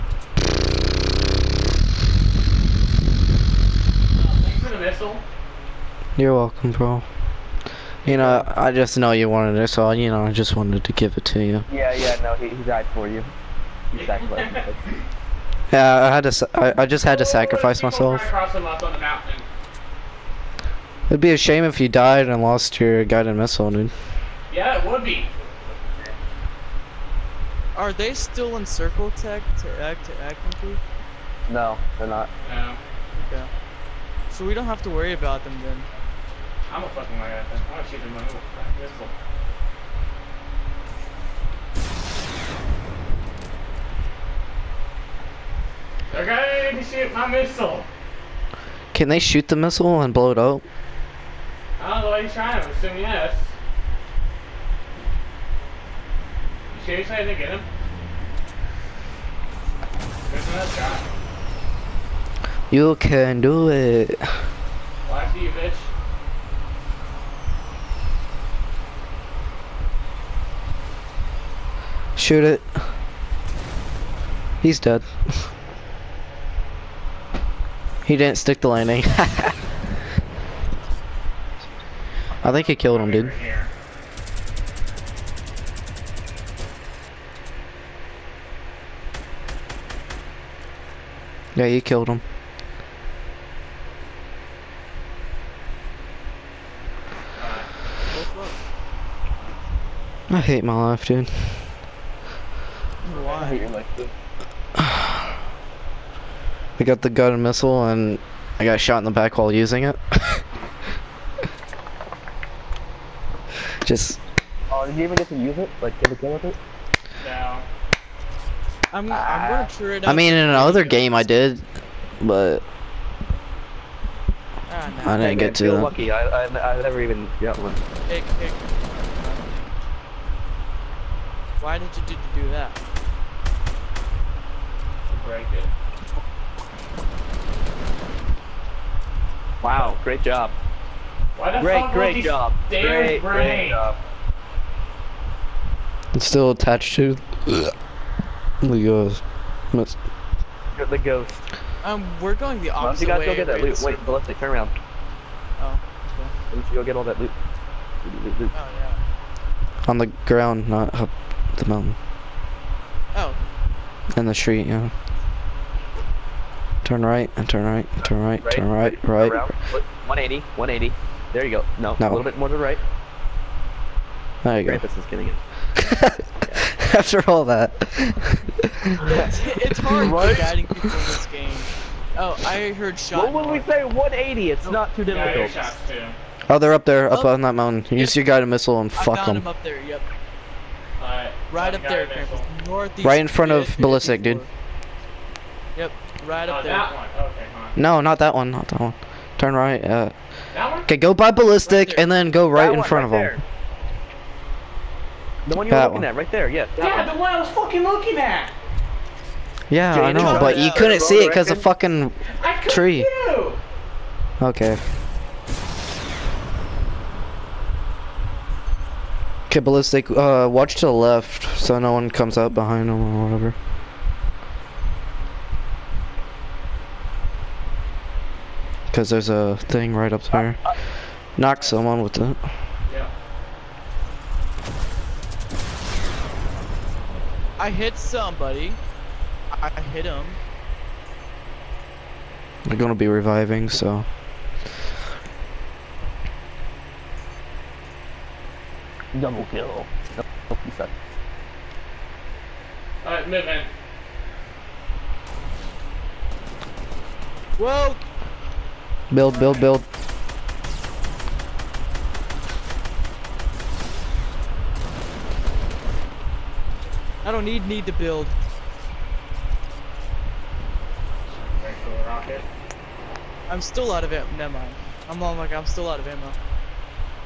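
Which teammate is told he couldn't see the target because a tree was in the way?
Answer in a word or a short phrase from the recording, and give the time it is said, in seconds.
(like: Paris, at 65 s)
Jay, at 209 s.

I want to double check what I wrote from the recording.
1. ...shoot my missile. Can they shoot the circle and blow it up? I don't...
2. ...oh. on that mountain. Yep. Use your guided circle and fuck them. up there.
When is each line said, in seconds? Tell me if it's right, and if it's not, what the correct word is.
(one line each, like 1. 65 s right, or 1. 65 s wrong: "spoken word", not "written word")
1. 46 s wrong: "missile", not "circle"
2. 187 s wrong: "missile", not "circle".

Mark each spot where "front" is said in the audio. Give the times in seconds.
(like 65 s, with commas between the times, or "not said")
193 s, 202 s.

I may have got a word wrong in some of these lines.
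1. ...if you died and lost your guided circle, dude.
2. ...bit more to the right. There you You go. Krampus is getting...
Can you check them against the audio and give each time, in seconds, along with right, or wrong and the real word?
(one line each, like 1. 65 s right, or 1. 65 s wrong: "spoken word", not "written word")
1. 21 s wrong: "missile", not "circle"
2. 172 s wrong: "Krampus", not "You".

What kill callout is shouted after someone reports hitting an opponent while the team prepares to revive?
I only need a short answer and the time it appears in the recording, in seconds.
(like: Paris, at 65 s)
Double kill, at 249 s.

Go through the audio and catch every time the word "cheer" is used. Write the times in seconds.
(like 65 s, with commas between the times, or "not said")
119 s.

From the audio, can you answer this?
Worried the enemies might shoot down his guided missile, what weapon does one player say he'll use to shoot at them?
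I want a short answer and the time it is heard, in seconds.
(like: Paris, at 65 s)
pistol, at 38 s.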